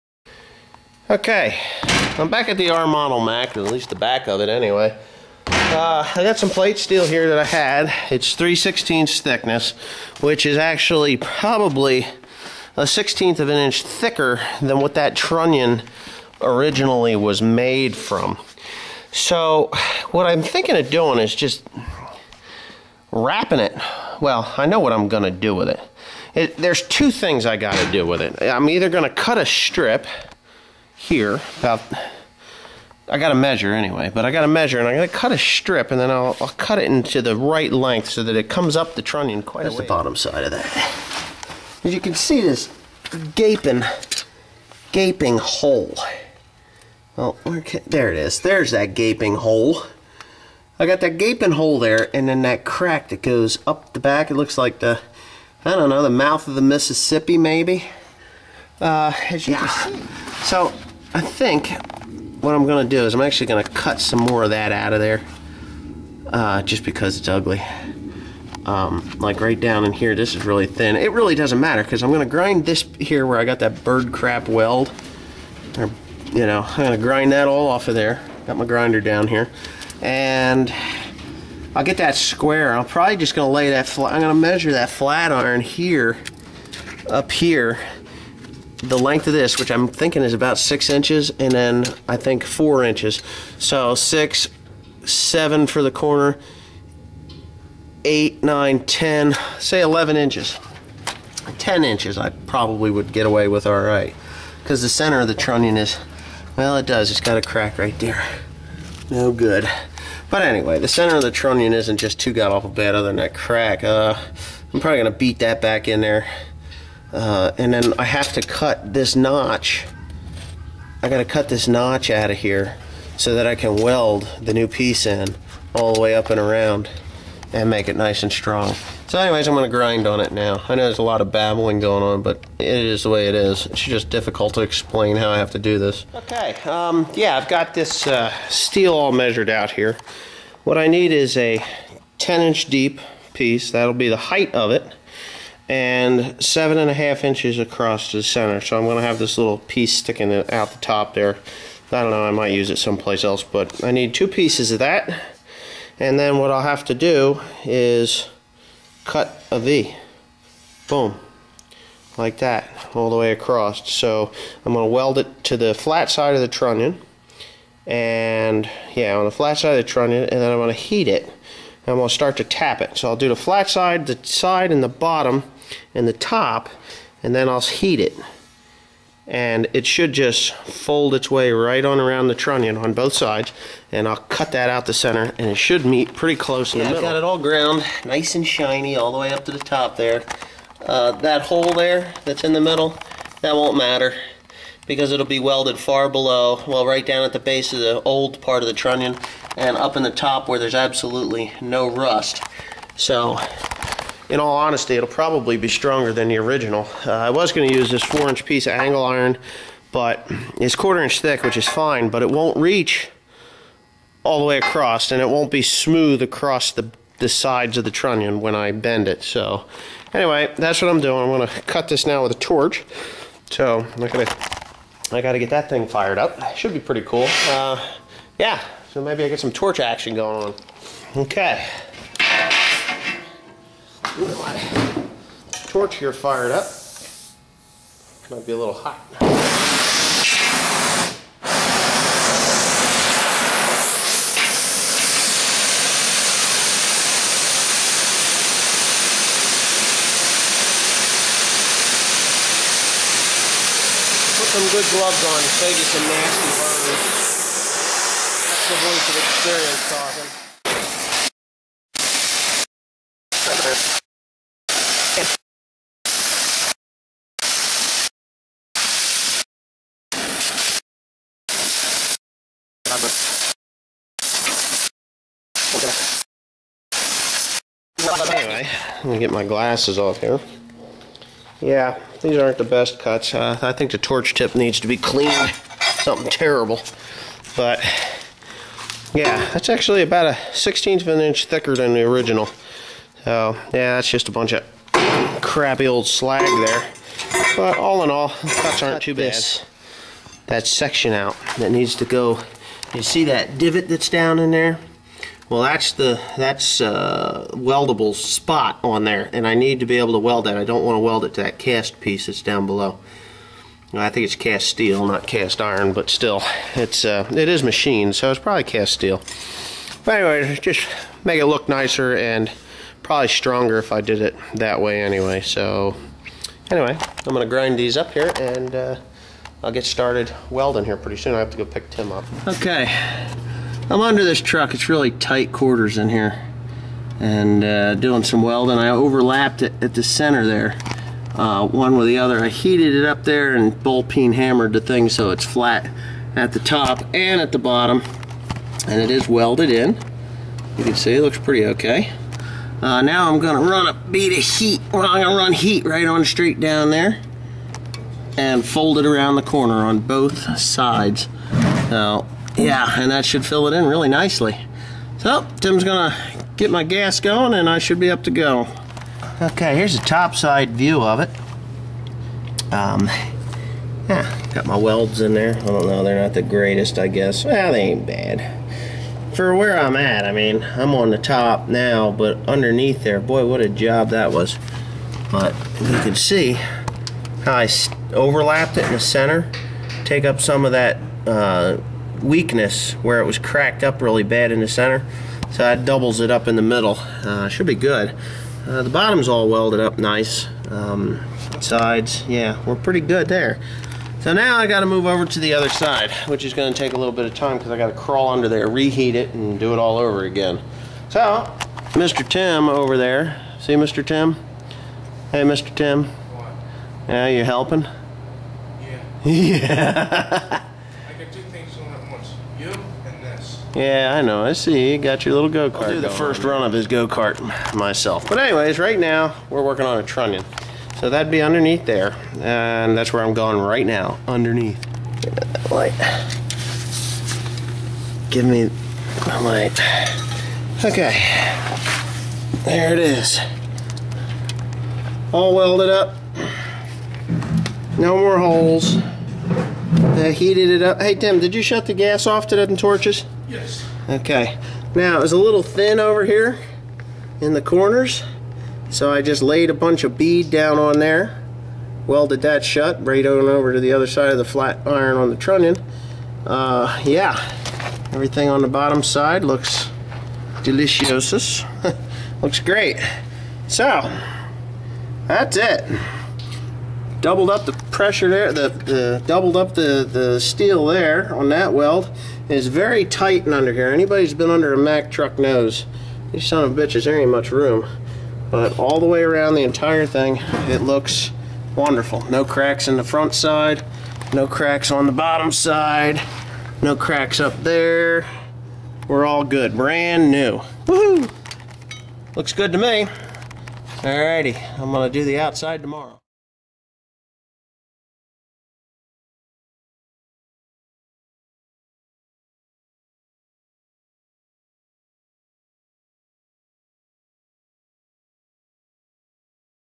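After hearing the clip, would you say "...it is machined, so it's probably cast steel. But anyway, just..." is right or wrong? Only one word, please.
right.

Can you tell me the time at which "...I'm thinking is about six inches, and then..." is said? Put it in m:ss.
1:29.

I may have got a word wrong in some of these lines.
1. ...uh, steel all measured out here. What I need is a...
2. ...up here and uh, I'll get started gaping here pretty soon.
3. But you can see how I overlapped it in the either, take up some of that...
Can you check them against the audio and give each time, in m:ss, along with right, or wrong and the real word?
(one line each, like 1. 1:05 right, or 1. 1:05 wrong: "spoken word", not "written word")
1. 2:18 right
2. 5:27 wrong: "welding", not "gaping"
3. 6:25 wrong: "center", not "either".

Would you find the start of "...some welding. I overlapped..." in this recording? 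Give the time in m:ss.
5:38.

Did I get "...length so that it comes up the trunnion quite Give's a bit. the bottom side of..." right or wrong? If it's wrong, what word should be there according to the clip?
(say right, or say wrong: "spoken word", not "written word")
wrong: "That", not "Give".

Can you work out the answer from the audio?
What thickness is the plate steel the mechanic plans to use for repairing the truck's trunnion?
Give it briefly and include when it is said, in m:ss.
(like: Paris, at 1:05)
3/16 inch, at 0:08.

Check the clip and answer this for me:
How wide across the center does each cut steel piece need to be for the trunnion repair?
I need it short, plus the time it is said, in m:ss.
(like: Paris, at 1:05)
7.5 inches, at 2:26.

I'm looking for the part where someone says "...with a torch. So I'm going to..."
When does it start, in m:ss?
3:42.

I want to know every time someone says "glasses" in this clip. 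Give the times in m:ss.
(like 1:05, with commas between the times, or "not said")
4:39.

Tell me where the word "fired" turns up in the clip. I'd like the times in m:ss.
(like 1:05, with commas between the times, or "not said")
3:45, 3:56.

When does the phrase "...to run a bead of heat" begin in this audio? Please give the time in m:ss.
5:53.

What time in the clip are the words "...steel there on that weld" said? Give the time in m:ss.
8:00.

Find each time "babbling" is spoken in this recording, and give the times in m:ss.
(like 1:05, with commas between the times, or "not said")
2:11.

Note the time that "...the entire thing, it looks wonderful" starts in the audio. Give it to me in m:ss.
8:09.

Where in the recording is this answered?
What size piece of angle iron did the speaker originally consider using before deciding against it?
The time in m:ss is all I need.
3:28.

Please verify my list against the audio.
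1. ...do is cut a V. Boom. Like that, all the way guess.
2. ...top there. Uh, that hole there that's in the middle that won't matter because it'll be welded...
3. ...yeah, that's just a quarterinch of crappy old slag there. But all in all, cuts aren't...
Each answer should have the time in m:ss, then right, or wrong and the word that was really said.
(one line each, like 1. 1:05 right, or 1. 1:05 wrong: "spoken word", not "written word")
1. 2:36 wrong: "across", not "guess"
2. 3:09 right
3. 4:53 wrong: "bunch", not "quarterinch".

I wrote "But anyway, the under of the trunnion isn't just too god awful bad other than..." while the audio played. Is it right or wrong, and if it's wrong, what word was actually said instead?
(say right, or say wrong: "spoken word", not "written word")
wrong: "center", not "under".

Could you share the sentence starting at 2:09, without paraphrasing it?
So anyways, I'm gonna grind on it now.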